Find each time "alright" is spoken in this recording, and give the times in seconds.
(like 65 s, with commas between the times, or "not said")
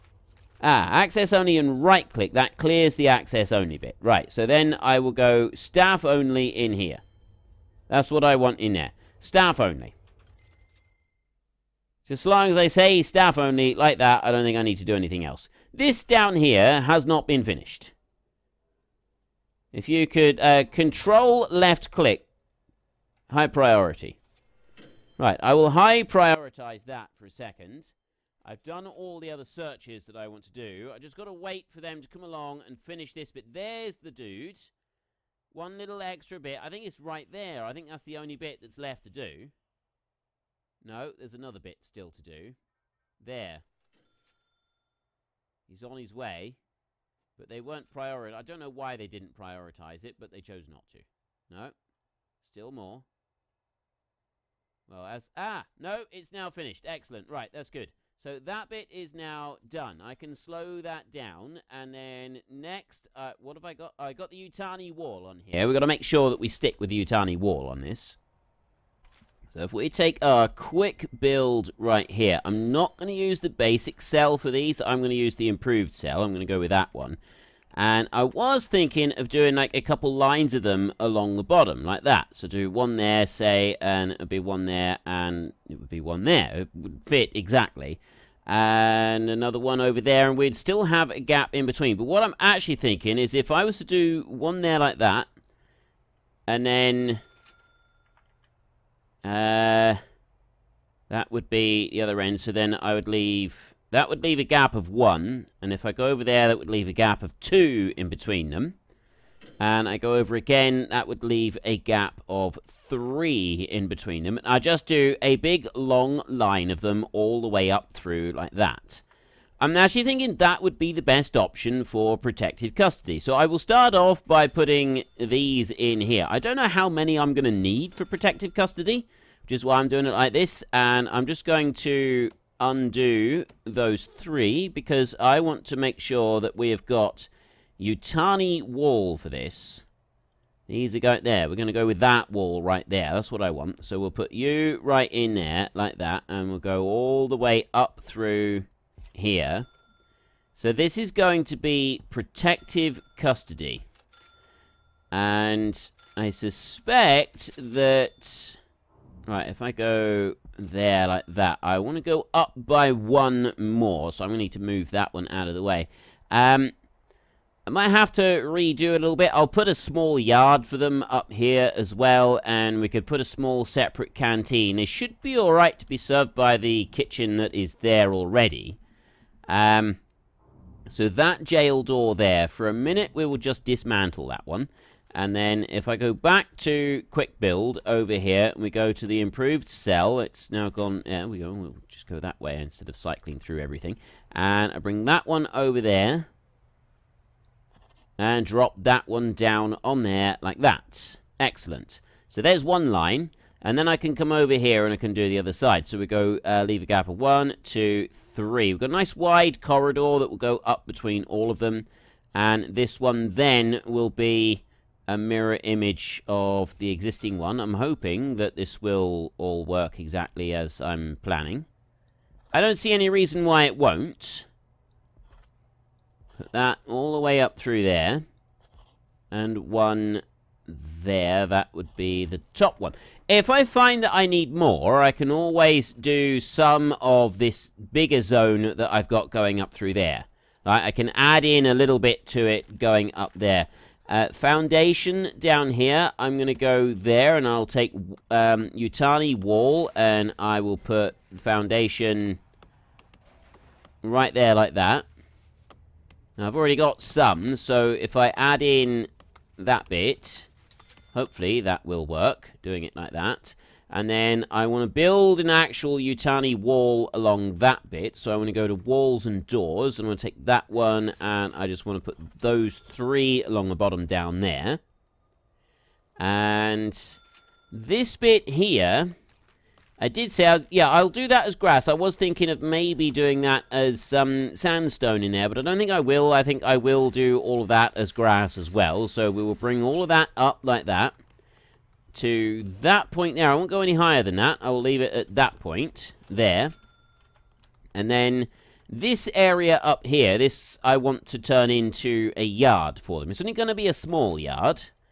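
175 s.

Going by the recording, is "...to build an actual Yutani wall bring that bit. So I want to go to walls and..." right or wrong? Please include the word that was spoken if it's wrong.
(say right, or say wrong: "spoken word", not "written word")
wrong: "along", not "bring".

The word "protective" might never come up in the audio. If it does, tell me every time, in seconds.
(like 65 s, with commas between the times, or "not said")
122 s, 128 s, 152 s.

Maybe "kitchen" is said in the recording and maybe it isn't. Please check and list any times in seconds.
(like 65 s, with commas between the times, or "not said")
176 s.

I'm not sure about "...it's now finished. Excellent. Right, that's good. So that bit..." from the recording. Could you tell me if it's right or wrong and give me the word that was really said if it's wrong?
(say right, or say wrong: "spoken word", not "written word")
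right.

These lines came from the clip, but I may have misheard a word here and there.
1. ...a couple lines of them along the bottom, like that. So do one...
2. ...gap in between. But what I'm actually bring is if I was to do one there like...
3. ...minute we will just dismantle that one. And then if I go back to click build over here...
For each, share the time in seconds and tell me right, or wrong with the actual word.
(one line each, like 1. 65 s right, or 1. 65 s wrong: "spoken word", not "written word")
1. 79 s right
2. 91 s wrong: "thinking", not "bring"
3. 182 s wrong: "quick", not "click".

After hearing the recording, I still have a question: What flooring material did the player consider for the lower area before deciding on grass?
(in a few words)
sandstone.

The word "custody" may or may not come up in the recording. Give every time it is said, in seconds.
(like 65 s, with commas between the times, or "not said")
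122 s, 128 s, 153 s.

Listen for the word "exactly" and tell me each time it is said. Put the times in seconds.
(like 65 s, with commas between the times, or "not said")
87 s, 219 s.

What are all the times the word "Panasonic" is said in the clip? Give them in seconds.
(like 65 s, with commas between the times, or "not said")
not said.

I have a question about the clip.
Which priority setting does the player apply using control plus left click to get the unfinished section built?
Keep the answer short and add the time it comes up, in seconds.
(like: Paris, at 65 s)
High priority, at 23 s.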